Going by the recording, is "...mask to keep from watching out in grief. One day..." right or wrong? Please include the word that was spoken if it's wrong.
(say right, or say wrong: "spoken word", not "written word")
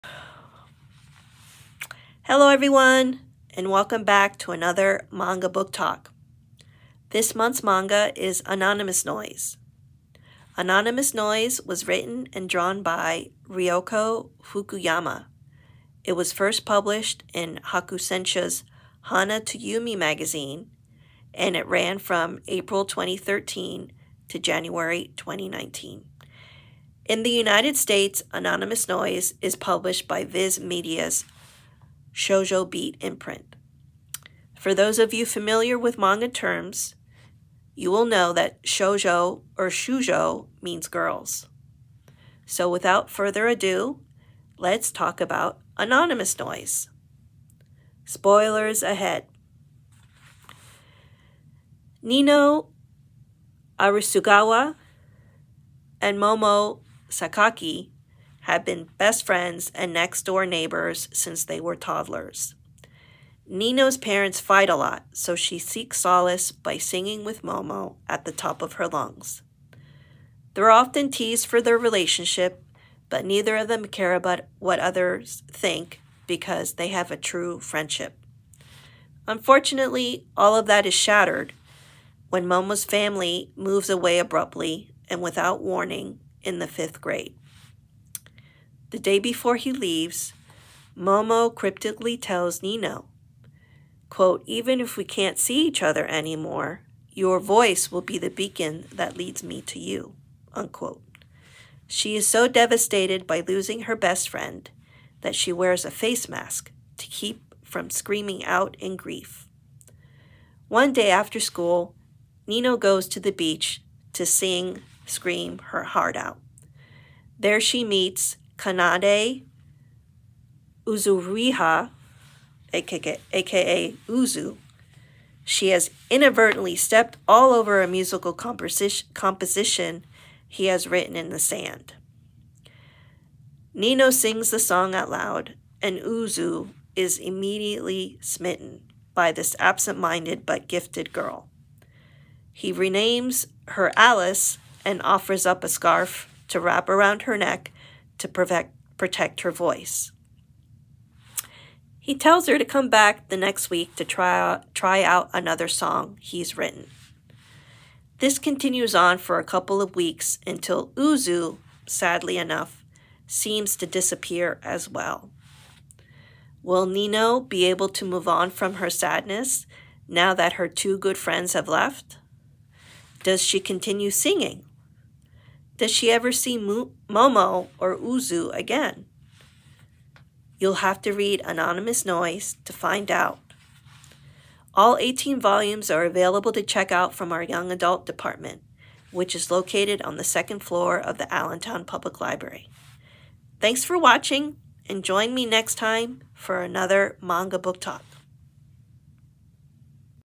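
wrong: "screaming", not "watching".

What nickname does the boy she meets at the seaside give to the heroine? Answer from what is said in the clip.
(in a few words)
Alice.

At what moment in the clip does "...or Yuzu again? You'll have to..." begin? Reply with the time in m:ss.
2:57.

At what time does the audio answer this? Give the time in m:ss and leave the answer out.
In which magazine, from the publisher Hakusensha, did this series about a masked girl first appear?
0:19.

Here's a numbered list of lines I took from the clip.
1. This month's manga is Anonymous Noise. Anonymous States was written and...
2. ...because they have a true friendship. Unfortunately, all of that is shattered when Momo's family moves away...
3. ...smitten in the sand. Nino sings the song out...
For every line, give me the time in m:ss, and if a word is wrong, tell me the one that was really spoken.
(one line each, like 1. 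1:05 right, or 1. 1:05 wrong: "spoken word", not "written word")
1. 0:07 wrong: "Noise", not "States"
2. 1:16 right
3. 2:10 wrong: "written", not "smitten".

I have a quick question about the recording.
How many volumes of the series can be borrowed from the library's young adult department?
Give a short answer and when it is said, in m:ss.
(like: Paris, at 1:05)
18, at 3:04.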